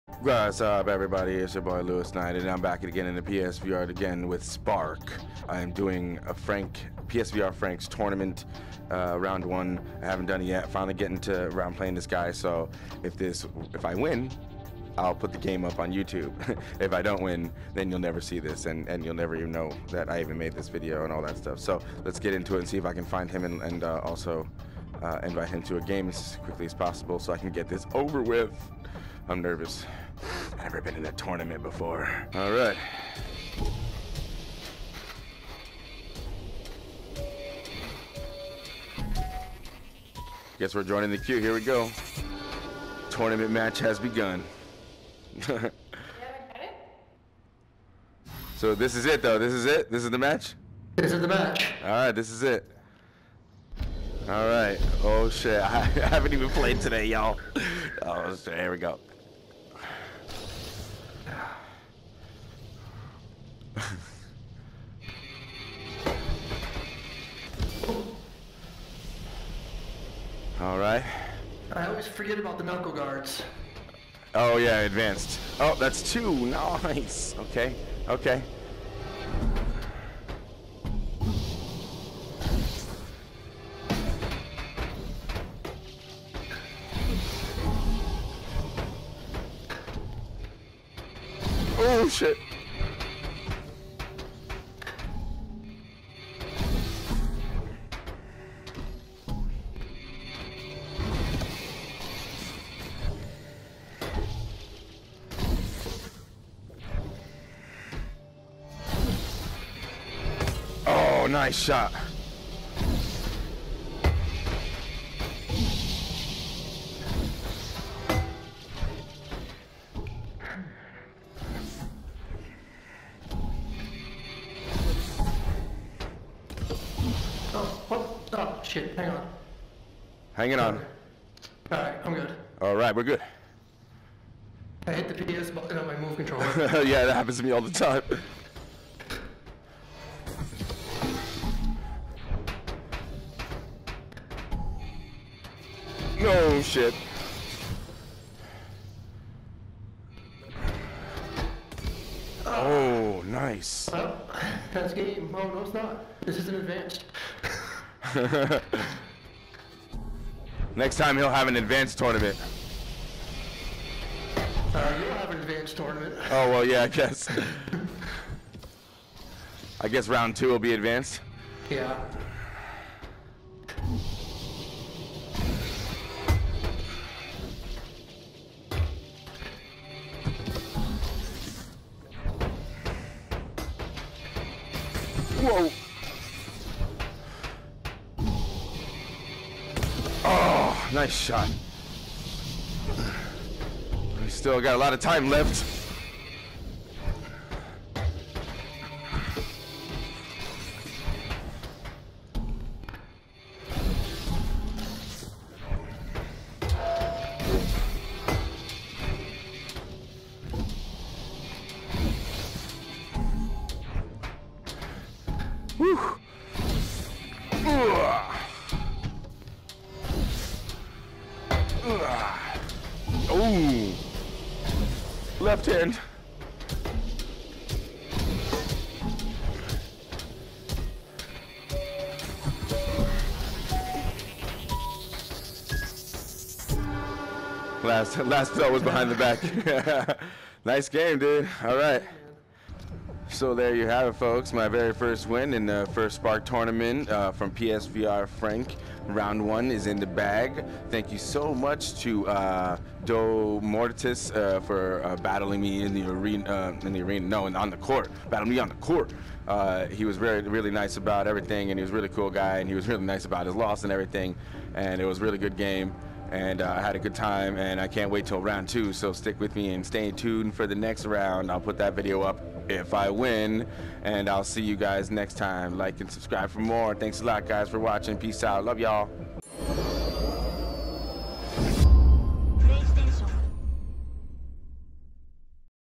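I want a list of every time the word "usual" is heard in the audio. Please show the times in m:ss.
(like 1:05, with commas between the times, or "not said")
not said.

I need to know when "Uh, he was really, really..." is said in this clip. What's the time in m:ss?
4:19.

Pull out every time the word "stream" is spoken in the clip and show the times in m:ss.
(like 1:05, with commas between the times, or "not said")
not said.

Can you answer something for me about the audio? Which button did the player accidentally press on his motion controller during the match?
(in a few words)
PS button.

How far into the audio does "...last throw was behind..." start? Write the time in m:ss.
3:58.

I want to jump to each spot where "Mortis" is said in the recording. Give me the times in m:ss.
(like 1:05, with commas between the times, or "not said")
4:13.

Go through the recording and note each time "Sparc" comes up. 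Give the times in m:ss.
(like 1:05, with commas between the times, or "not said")
0:04, 4:06.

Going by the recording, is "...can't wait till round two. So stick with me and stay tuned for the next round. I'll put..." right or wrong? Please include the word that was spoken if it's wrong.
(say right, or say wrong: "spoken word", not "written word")
right.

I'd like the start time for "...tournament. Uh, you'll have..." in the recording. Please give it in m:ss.
2:41.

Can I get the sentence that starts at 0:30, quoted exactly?
Never been in a tournament before.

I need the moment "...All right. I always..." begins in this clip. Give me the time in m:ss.
1:10.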